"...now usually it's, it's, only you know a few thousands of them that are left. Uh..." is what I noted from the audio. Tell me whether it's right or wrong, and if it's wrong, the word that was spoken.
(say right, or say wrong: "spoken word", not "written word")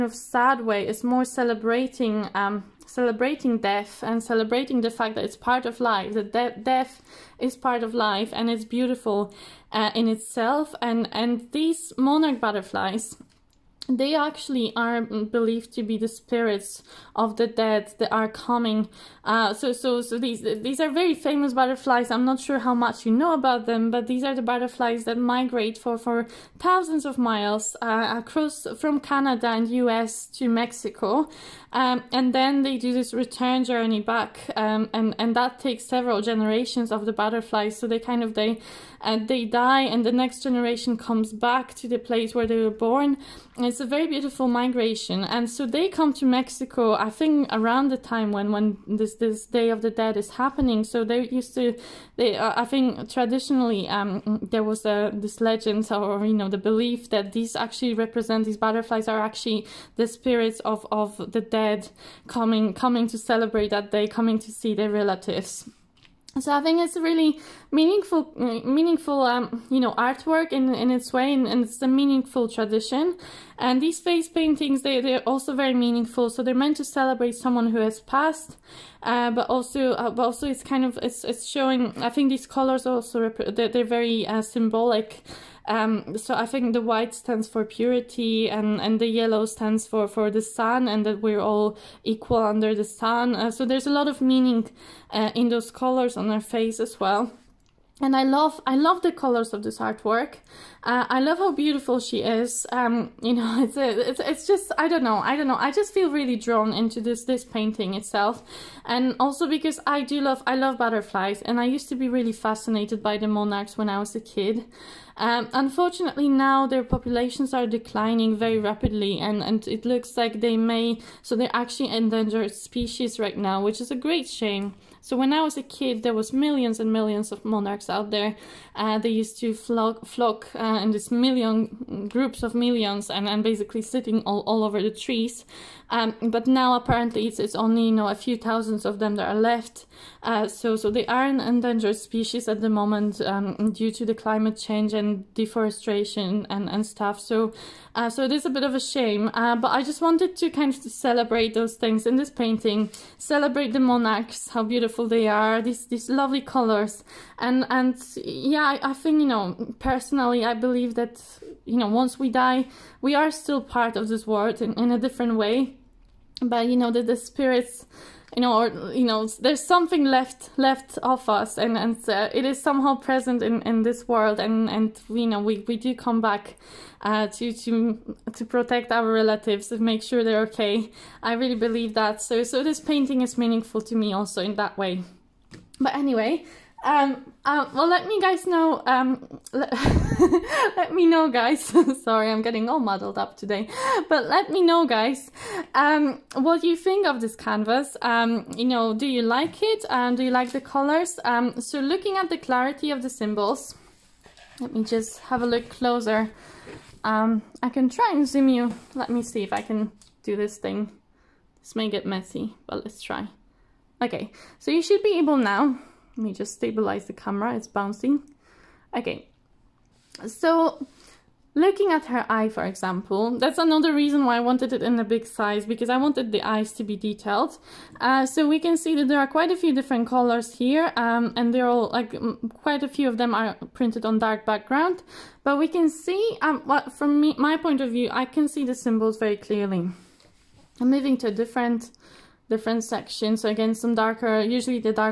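wrong: "apparently", not "usually".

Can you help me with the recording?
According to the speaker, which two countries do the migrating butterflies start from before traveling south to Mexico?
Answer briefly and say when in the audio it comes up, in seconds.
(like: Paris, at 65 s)
Canada and U.S., at 29 s.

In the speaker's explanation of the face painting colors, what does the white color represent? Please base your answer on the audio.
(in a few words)
Purity.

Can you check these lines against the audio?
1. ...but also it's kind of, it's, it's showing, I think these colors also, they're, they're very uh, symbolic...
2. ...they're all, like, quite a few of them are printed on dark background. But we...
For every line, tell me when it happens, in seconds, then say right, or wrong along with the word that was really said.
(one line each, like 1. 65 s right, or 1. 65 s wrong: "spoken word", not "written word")
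1. 80 s right
2. 231 s right.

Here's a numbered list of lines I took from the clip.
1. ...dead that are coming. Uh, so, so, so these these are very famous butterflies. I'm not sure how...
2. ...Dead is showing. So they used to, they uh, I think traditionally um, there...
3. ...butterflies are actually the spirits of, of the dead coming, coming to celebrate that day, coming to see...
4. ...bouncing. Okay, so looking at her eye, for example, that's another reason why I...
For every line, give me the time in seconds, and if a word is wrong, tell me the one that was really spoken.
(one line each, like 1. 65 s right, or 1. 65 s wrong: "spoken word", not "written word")
1. 17 s right
2. 49 s wrong: "happening", not "showing"
3. 58 s right
4. 217 s right.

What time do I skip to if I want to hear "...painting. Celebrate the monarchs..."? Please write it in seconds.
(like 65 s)
152 s.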